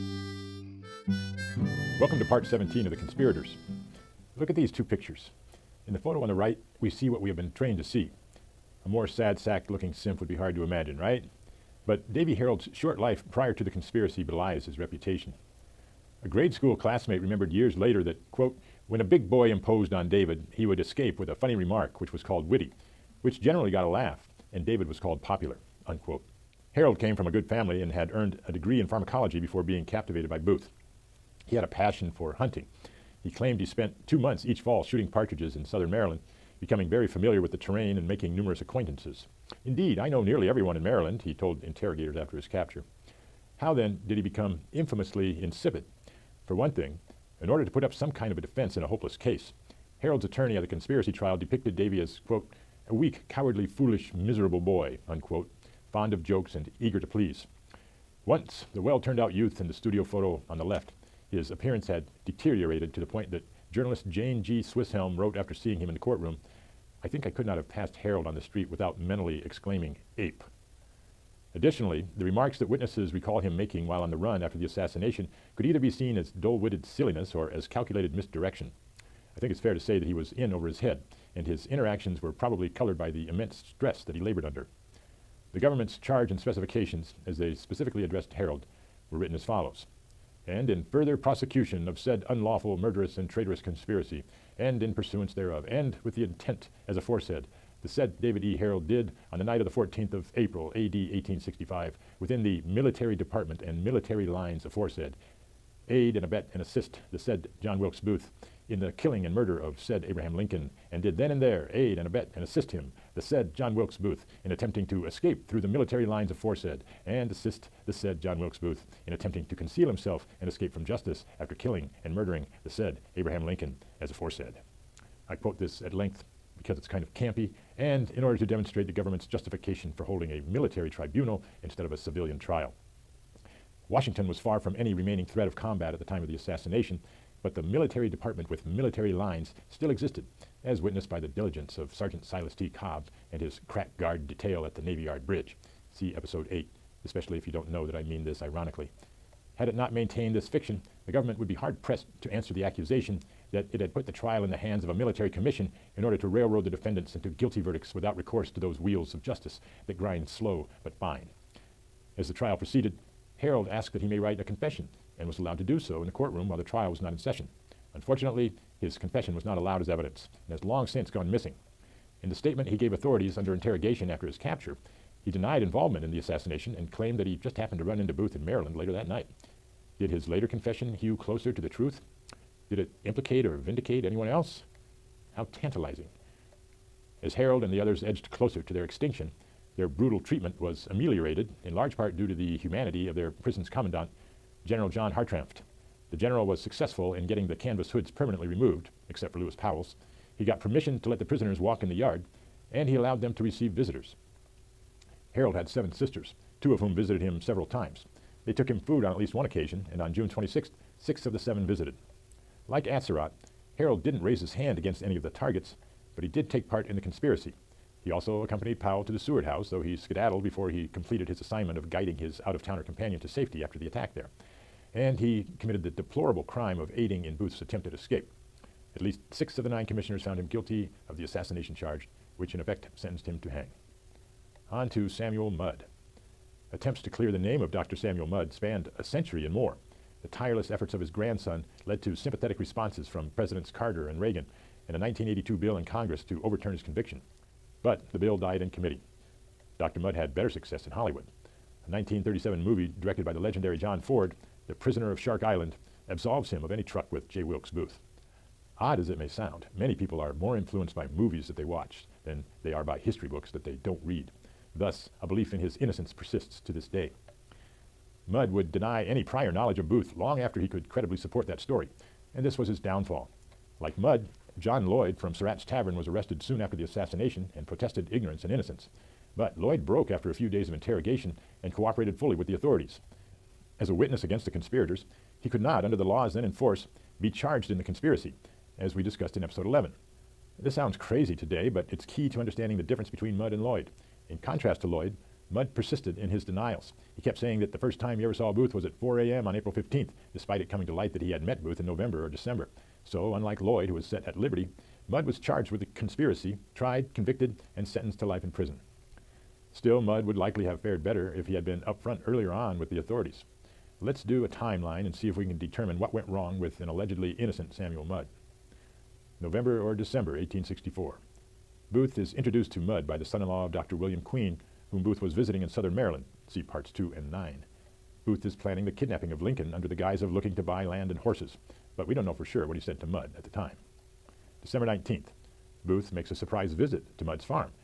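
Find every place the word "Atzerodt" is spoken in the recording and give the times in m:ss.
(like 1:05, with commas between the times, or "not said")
3:32.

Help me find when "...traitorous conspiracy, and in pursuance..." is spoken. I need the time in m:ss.
1:33.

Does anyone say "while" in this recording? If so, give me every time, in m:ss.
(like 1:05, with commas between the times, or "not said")
1:13, 2:46.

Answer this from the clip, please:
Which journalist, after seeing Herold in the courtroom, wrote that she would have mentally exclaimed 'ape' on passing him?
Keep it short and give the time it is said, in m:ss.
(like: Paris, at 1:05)
Jane G. Swisshelm, at 1:04.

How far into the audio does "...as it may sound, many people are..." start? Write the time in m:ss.
4:18.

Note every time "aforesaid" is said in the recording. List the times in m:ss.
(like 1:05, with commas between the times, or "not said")
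1:36, 1:44, 1:56, 2:04.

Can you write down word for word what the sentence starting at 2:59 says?
Did his later confession hew closer to the truth?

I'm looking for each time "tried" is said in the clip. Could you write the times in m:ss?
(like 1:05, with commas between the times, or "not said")
5:06.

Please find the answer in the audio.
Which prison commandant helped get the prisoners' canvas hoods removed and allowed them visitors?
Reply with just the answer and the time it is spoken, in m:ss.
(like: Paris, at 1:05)
John Hartranft, at 3:14.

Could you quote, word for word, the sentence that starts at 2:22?
Cobb and his crack guard detail at the Navy Yard Bridge.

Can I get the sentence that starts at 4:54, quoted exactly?
In contrast to Lloyd, Mudd persisted in his denials.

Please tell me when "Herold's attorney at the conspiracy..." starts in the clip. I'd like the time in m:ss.
0:50.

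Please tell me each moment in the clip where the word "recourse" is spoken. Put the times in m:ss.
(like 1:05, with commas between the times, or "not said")
2:38.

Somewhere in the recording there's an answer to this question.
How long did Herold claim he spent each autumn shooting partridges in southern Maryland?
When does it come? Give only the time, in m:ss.
0:34.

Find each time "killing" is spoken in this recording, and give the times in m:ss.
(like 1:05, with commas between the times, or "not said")
1:48, 2:01.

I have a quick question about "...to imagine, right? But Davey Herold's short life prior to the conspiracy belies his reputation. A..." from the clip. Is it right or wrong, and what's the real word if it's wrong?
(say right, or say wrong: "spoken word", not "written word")
right.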